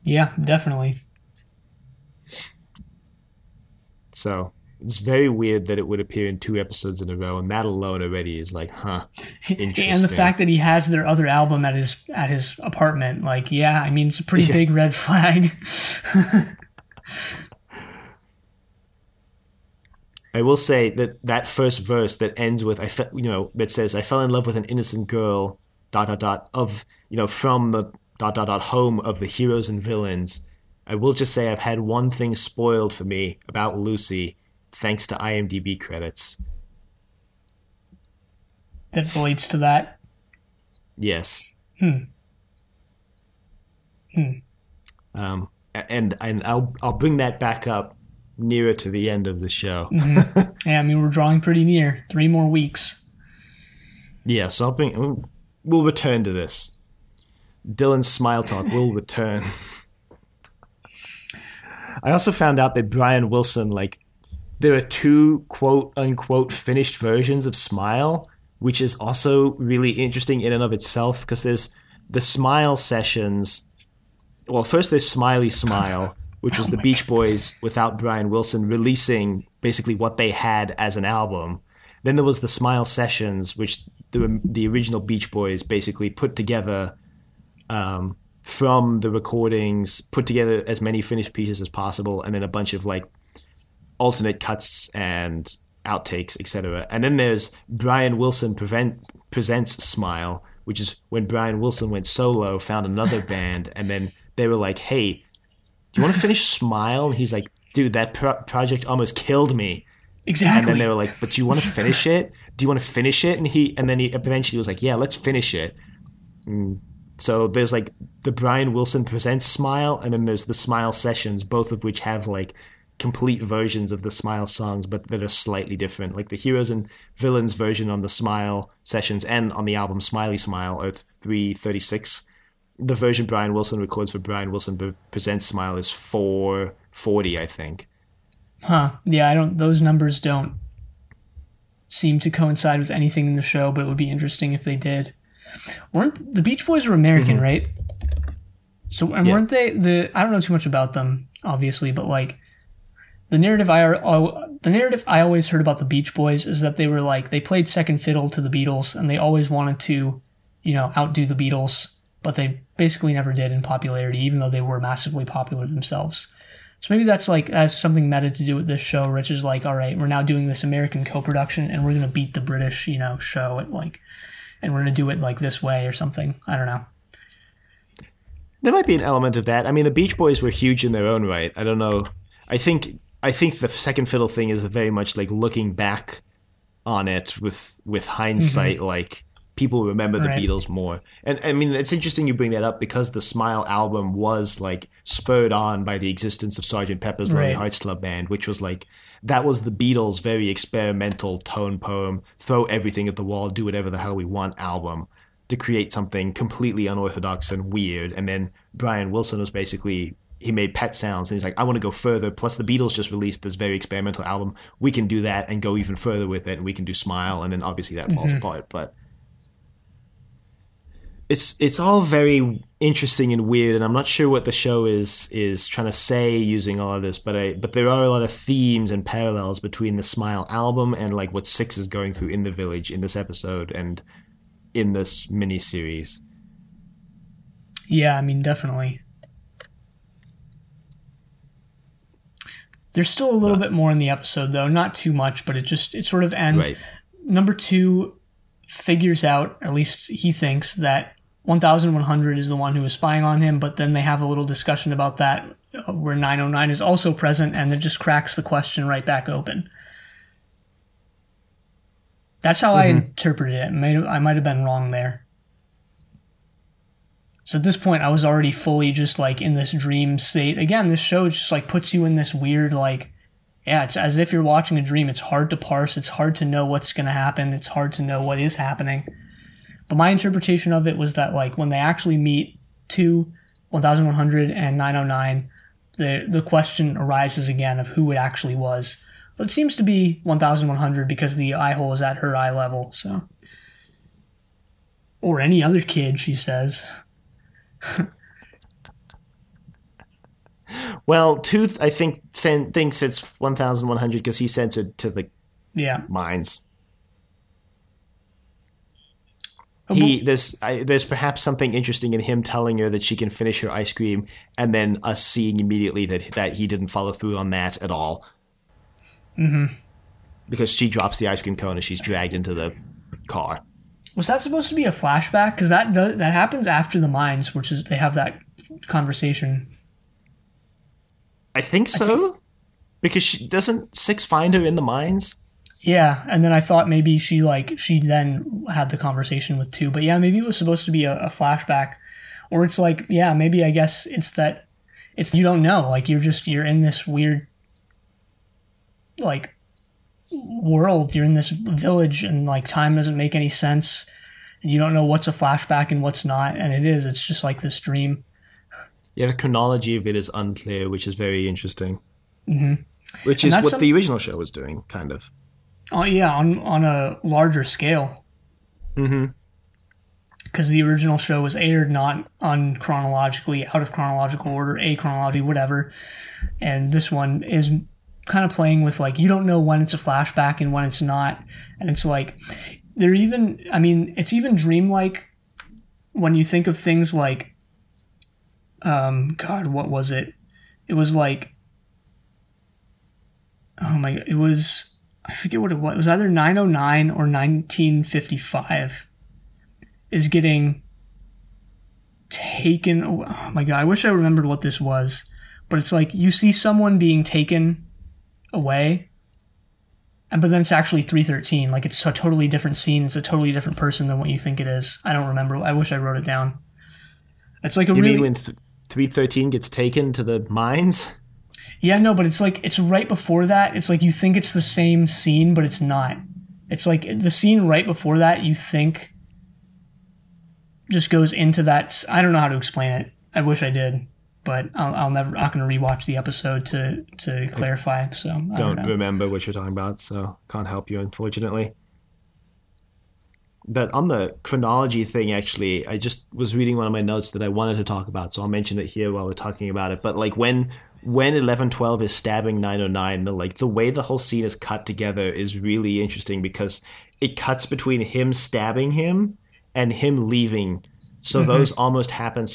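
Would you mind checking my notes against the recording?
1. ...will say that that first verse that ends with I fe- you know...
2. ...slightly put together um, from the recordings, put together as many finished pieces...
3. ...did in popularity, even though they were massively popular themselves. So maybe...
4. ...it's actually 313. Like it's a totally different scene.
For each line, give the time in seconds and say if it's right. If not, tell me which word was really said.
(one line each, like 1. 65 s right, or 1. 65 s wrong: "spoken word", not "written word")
1. 20 s right
2. 85 s wrong: "basically", not "slightly"
3. 163 s right
4. 410 s right.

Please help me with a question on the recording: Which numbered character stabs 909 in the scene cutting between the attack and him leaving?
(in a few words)
1112.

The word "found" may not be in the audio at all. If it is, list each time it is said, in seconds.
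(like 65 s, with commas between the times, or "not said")
62 s, 102 s.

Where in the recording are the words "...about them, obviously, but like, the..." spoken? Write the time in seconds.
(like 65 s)
150 s.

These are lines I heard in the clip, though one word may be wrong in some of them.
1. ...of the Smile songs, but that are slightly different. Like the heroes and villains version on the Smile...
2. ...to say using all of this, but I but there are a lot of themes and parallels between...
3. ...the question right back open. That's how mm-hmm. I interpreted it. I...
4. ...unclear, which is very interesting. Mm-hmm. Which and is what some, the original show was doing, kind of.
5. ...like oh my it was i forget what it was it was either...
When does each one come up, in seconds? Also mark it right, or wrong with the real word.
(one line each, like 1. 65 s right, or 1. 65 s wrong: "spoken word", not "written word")
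1. 123 s right
2. 225 s right
3. 258 s right
4. 360 s right
5. 391 s right.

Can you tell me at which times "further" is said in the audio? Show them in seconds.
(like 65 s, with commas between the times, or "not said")
211 s, 215 s.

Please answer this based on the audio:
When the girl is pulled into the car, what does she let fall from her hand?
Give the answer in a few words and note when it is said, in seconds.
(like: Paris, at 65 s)
ice cream cone, at 321 s.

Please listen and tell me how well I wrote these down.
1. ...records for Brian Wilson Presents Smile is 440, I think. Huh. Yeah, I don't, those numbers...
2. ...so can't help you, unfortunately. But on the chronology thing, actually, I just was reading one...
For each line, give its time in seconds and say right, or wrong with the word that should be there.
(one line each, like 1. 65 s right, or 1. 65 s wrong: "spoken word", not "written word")
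1. 133 s right
2. 440 s right.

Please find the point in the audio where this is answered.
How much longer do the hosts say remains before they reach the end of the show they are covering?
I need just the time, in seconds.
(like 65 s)
52 s.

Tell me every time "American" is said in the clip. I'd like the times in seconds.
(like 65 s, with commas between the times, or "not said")
146 s, 170 s.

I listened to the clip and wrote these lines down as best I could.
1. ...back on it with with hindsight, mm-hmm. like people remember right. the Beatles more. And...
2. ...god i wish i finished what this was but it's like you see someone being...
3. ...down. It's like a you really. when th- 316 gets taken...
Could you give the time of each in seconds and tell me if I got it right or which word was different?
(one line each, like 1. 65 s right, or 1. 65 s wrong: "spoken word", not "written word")
1. 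185 s right
2. 403 s wrong: "remembered", not "finished"
3. 416 s wrong: "313", not "316".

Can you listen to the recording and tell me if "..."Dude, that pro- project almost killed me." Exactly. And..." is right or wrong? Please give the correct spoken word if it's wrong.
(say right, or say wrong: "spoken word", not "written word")
right.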